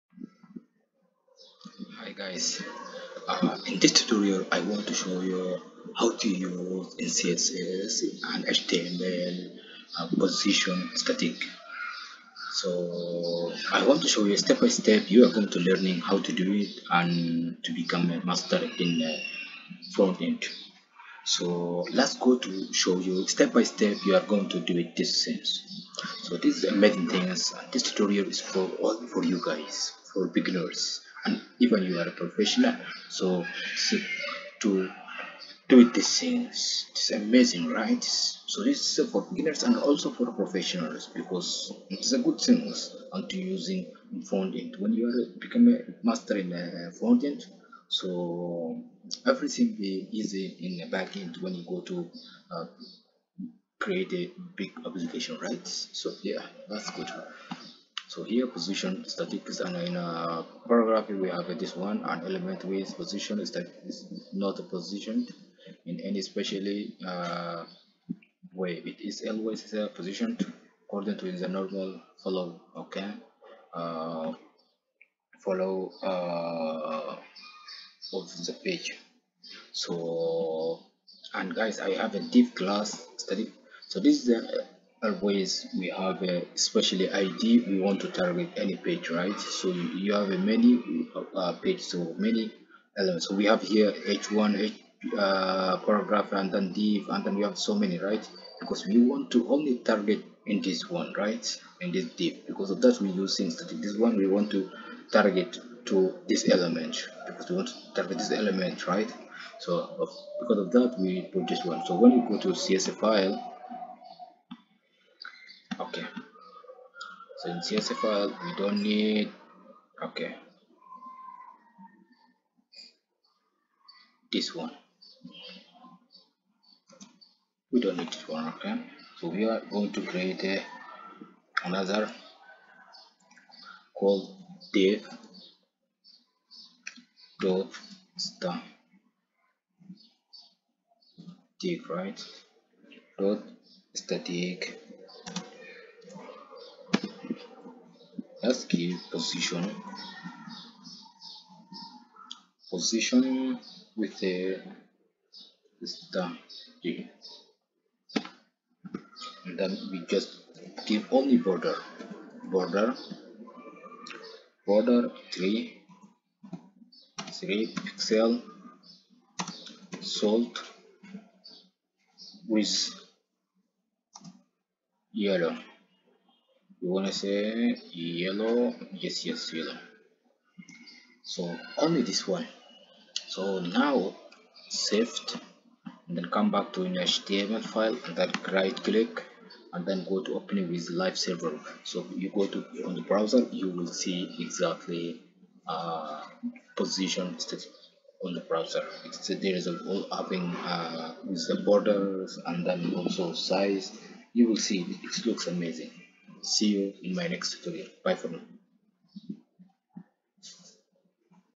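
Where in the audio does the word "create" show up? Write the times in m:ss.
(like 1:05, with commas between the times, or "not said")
0:53, 2:10.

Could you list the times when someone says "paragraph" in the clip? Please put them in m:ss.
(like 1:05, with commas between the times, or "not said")
1:00, 1:35.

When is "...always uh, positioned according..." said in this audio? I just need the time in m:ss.
1:09.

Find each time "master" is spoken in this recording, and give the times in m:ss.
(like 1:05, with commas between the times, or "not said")
0:18, 0:46.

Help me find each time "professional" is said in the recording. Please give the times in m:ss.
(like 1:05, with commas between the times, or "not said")
0:32, 0:40.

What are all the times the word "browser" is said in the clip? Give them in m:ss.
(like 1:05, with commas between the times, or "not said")
3:13, 3:18.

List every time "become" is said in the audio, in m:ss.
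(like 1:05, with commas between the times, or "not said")
0:17, 0:45.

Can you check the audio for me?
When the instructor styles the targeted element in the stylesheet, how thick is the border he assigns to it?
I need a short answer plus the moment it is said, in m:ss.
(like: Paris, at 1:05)
3 pixels, at 2:47.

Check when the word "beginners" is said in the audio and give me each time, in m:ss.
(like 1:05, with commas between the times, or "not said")
0:30, 0:39.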